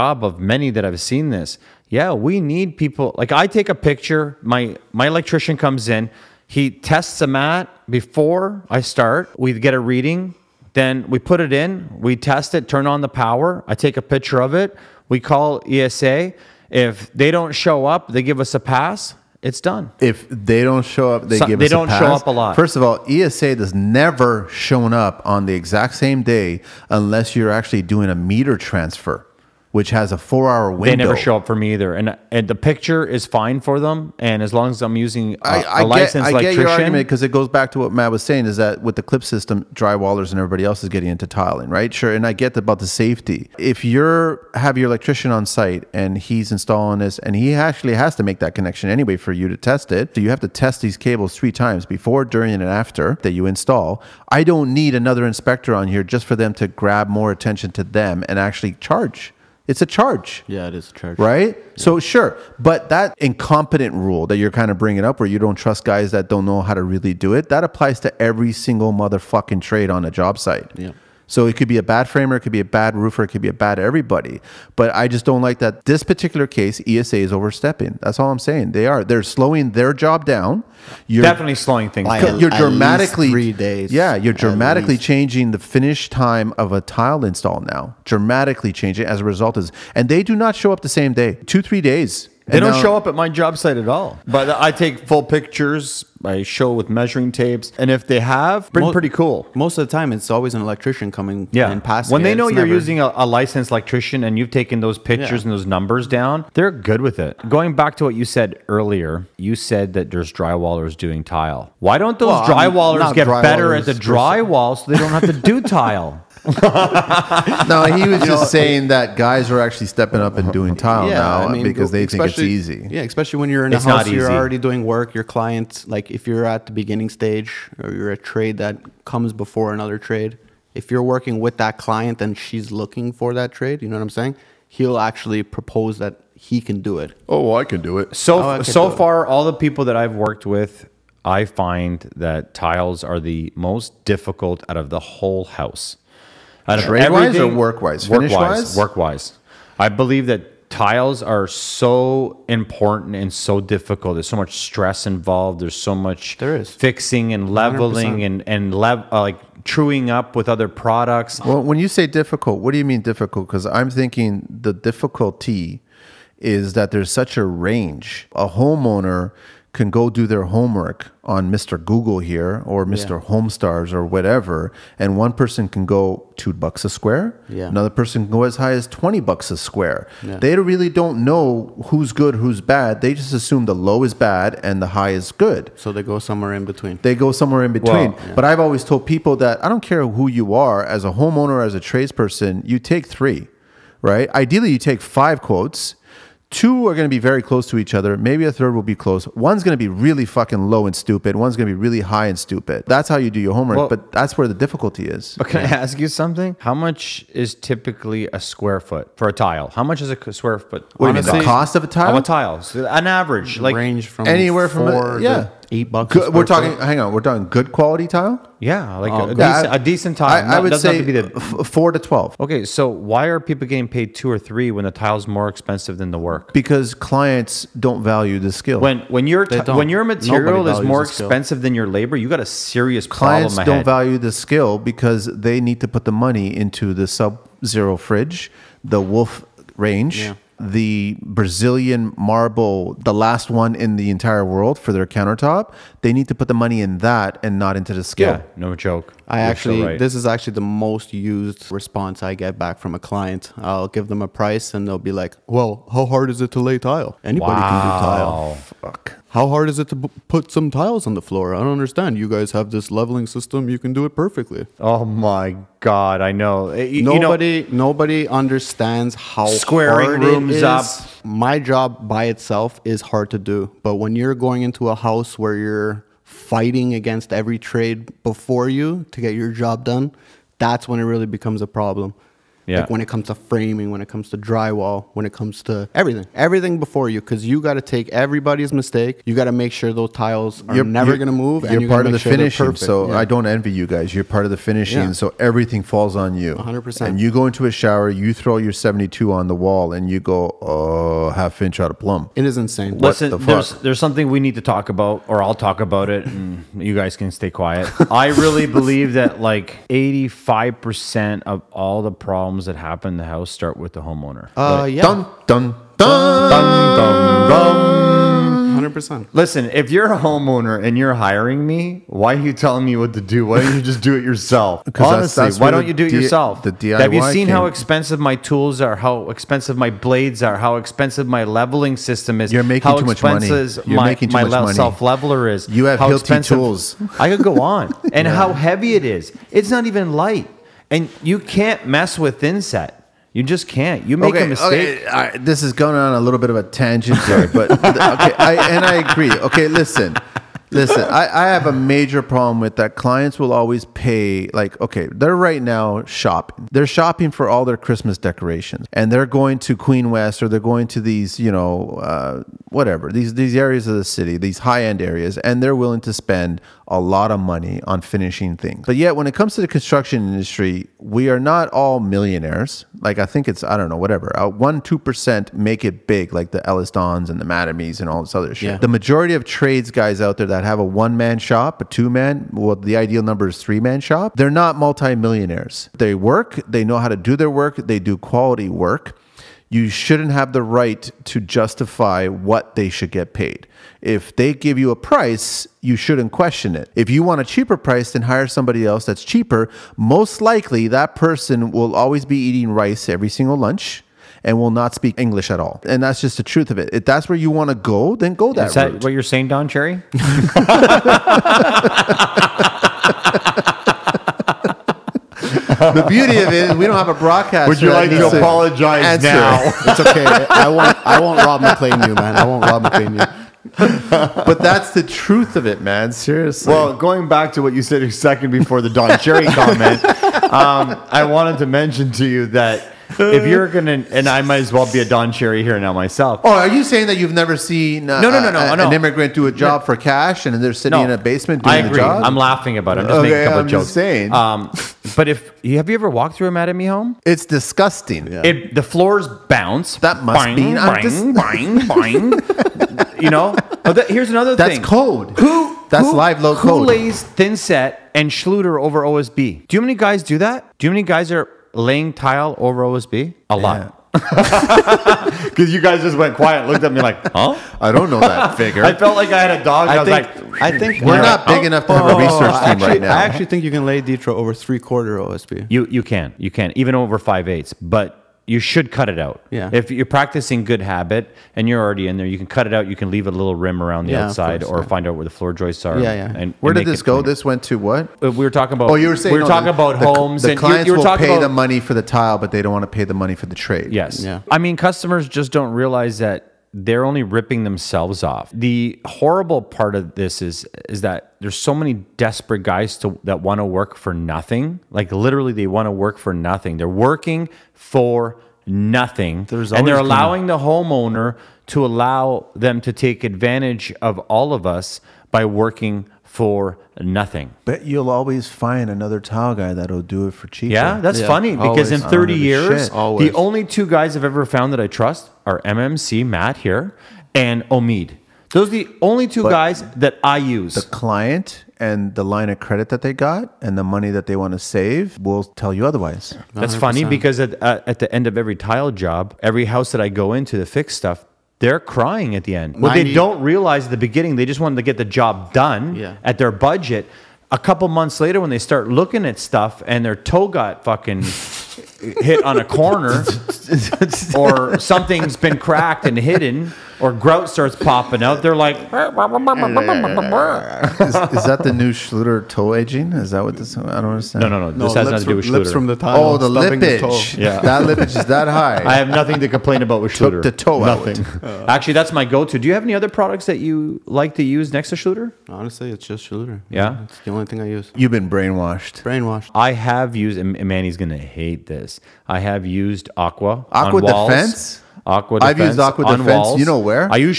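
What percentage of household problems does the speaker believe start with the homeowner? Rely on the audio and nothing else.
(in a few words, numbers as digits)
85%.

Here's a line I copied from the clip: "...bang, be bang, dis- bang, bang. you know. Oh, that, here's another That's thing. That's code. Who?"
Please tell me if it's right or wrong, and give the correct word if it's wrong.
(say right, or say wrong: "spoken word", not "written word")
right.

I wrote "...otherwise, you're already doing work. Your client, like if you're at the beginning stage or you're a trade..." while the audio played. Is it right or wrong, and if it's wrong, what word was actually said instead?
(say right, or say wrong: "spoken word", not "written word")
wrong: "house", not "otherwise".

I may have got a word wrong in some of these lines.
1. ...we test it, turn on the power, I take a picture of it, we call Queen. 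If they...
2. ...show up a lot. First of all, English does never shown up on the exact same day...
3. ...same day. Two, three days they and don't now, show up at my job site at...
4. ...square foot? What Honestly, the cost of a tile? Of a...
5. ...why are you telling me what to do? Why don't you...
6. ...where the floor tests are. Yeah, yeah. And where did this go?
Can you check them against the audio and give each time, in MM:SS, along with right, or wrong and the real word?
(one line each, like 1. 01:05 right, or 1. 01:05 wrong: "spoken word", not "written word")
1. 00:12 wrong: "ESA", not "Queen"
2. 00:21 wrong: "ESA", not "English"
3. 01:30 right
4. 03:30 right
5. 05:22 right
6. 08:05 wrong: "joists", not "tests".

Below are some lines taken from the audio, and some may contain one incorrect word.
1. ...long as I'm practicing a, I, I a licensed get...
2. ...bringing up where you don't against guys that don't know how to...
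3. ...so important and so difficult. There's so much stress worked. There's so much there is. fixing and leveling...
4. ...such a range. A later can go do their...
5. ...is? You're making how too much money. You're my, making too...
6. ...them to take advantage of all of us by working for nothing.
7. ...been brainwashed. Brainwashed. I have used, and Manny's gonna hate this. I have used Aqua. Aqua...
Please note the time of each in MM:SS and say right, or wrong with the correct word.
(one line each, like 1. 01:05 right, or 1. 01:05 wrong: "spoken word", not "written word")
1. 00:34 wrong: "using", not "practicing"
2. 01:04 wrong: "trust", not "against"
3. 02:31 wrong: "involved", not "worked"
4. 02:47 wrong: "homeowner", not "later"
5. 05:32 right
6. 08:32 right
7. 09:38 right.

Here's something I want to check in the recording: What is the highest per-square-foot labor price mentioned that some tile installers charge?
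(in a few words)
20 dollars.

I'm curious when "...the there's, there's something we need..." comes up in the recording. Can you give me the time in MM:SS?
05:03.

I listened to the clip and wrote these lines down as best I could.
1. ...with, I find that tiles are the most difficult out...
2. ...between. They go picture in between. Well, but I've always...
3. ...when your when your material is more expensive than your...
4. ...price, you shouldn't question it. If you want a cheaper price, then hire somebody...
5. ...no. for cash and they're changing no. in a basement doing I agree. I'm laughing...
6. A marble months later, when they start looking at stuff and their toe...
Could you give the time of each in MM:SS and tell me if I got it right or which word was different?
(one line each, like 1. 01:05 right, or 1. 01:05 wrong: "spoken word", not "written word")
1. 02:20 right
2. 03:06 wrong: "somewhere", not "picture"
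3. 03:49 right
4. 06:34 right
5. 07:19 wrong: "sitting", not "changing"
6. 09:07 wrong: "couple", not "marble".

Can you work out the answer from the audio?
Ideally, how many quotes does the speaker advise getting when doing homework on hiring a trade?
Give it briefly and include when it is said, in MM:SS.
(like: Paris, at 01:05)
5, at 03:14.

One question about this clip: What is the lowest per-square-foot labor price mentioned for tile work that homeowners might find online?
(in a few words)
2 dollars.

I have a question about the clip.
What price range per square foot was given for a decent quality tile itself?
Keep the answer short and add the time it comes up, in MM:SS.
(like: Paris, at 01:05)
4 to 12 dollars, at 03:41.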